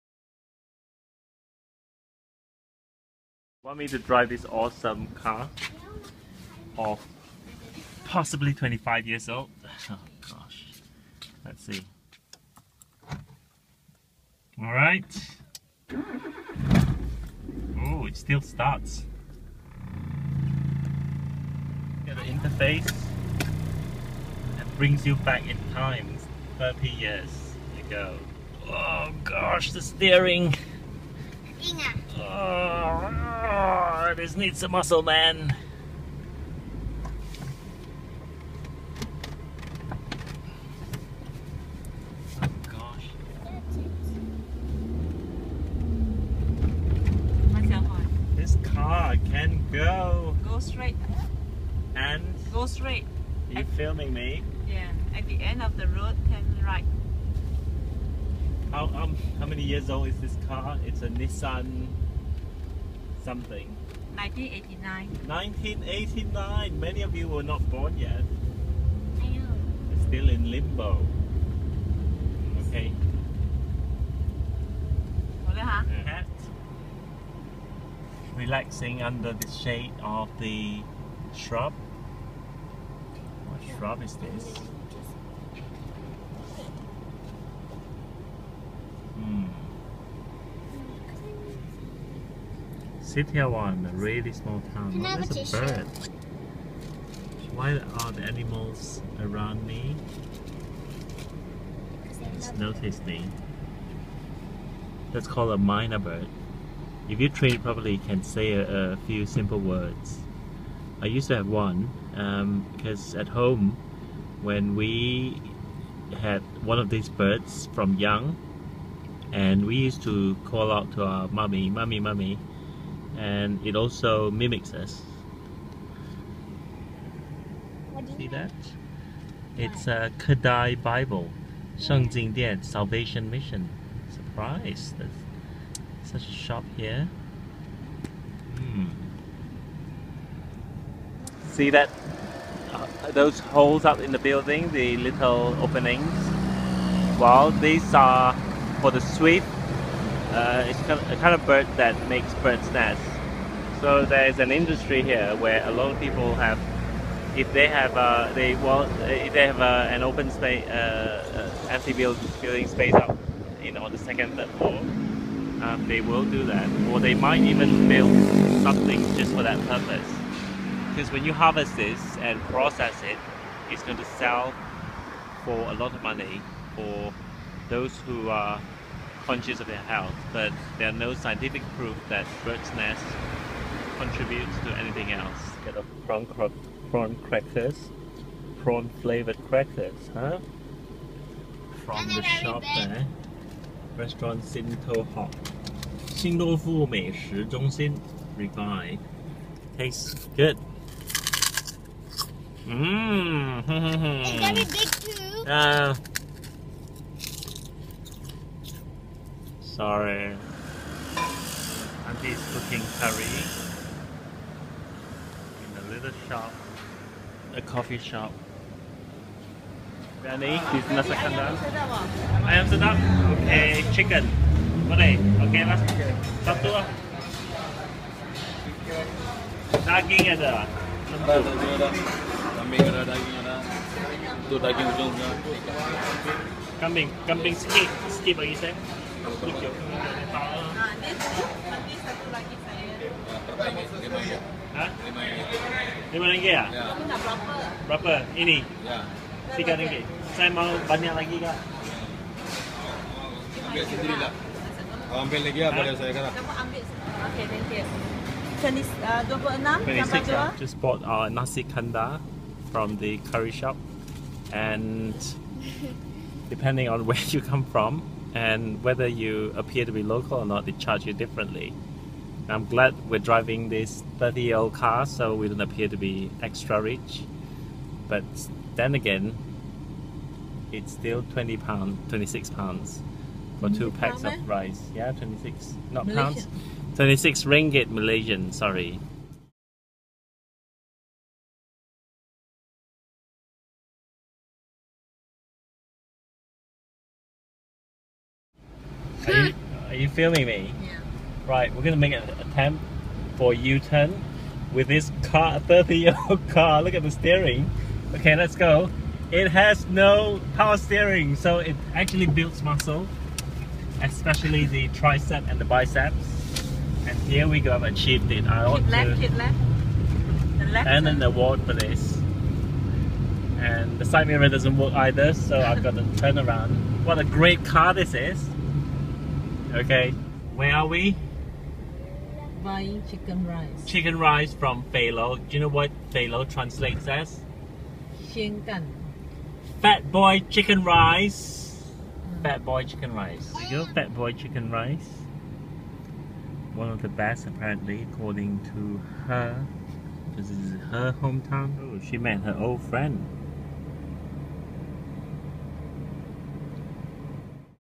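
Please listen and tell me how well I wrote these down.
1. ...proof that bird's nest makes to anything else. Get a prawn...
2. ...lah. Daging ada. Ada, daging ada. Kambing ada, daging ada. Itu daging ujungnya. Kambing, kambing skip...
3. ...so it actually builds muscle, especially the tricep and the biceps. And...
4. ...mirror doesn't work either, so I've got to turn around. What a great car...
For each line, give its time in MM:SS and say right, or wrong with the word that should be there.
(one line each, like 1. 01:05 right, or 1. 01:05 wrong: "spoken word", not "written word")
1. 03:01 wrong: "contributes", not "makes"
2. 03:46 right
3. 05:11 right
4. 05:24 right.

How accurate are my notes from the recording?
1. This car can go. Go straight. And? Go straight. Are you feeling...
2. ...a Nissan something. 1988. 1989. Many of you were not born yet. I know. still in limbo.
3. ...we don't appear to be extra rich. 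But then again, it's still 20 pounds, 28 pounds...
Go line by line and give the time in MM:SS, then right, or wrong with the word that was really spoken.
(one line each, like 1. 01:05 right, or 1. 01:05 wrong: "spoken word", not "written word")
1. 00:48 wrong: "filming", not "feeling"
2. 01:01 wrong: "1989", not "1988"
3. 04:35 wrong: "26", not "28".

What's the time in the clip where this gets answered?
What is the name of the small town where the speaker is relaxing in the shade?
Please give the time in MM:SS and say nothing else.
01:33.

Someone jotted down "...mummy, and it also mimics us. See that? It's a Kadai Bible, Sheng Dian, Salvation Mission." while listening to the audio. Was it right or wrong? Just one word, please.
right.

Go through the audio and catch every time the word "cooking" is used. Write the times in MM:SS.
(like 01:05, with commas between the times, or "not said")
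03:32.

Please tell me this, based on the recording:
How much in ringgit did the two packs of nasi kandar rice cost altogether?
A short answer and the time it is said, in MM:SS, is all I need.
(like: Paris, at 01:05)
26 ringgit, at 04:46.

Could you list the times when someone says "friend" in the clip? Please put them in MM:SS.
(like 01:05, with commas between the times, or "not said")
05:52.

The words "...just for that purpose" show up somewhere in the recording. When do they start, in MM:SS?
02:49.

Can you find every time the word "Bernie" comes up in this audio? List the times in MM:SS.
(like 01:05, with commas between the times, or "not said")
03:40.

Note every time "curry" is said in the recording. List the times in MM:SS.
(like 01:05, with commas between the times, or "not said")
03:32, 04:23.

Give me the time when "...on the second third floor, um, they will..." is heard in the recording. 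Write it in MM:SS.
02:43.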